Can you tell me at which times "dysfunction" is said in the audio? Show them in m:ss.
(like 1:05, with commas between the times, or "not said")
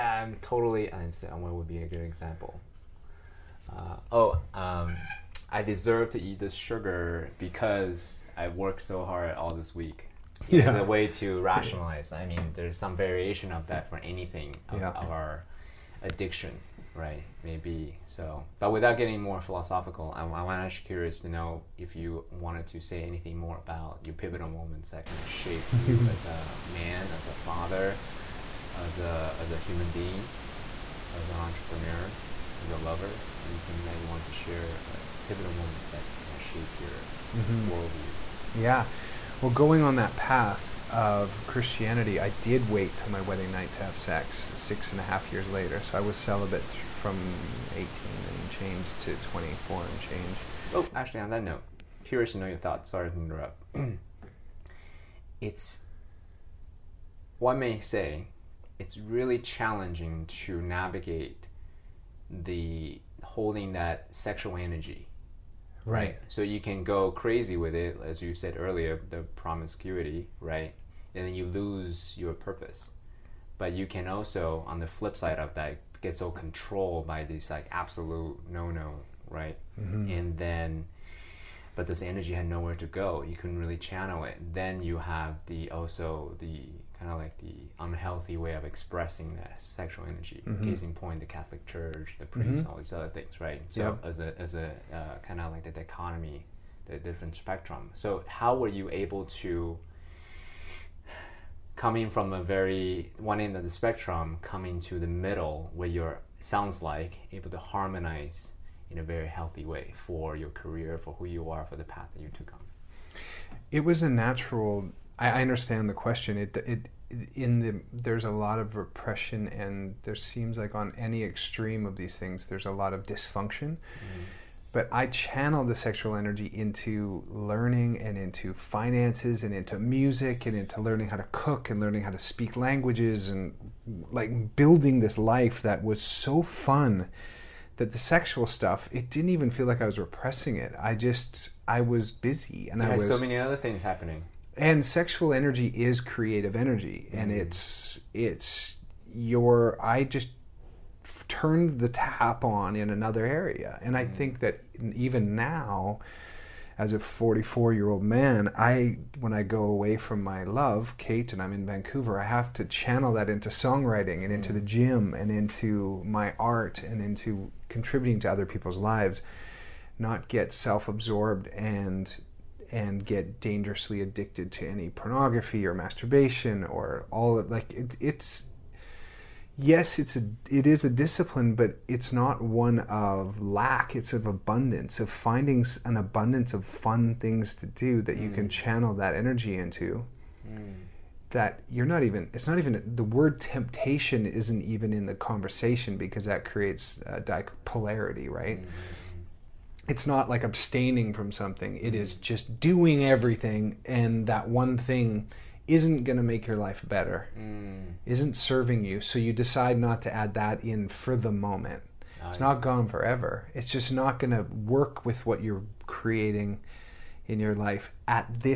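2:03.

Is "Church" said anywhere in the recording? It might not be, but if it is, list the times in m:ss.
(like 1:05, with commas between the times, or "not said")
1:31.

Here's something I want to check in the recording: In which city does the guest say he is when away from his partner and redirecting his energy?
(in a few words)
Vancouver.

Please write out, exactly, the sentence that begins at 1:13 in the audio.
But you can also, on the flip side of that, get so controlled by this like absolute no no, right?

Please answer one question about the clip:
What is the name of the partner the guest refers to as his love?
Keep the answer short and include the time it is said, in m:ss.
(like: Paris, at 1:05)
Kate, at 2:40.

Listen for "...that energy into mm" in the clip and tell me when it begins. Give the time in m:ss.
3:08.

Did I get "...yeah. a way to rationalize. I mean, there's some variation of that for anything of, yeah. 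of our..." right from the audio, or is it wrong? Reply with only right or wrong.
right.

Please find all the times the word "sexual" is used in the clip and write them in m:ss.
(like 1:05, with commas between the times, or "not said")
1:04, 1:29, 2:05, 2:17, 2:24.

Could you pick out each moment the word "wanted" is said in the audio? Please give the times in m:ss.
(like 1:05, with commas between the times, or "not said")
0:22, 0:34.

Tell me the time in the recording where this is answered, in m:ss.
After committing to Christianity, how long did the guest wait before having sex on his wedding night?
0:44.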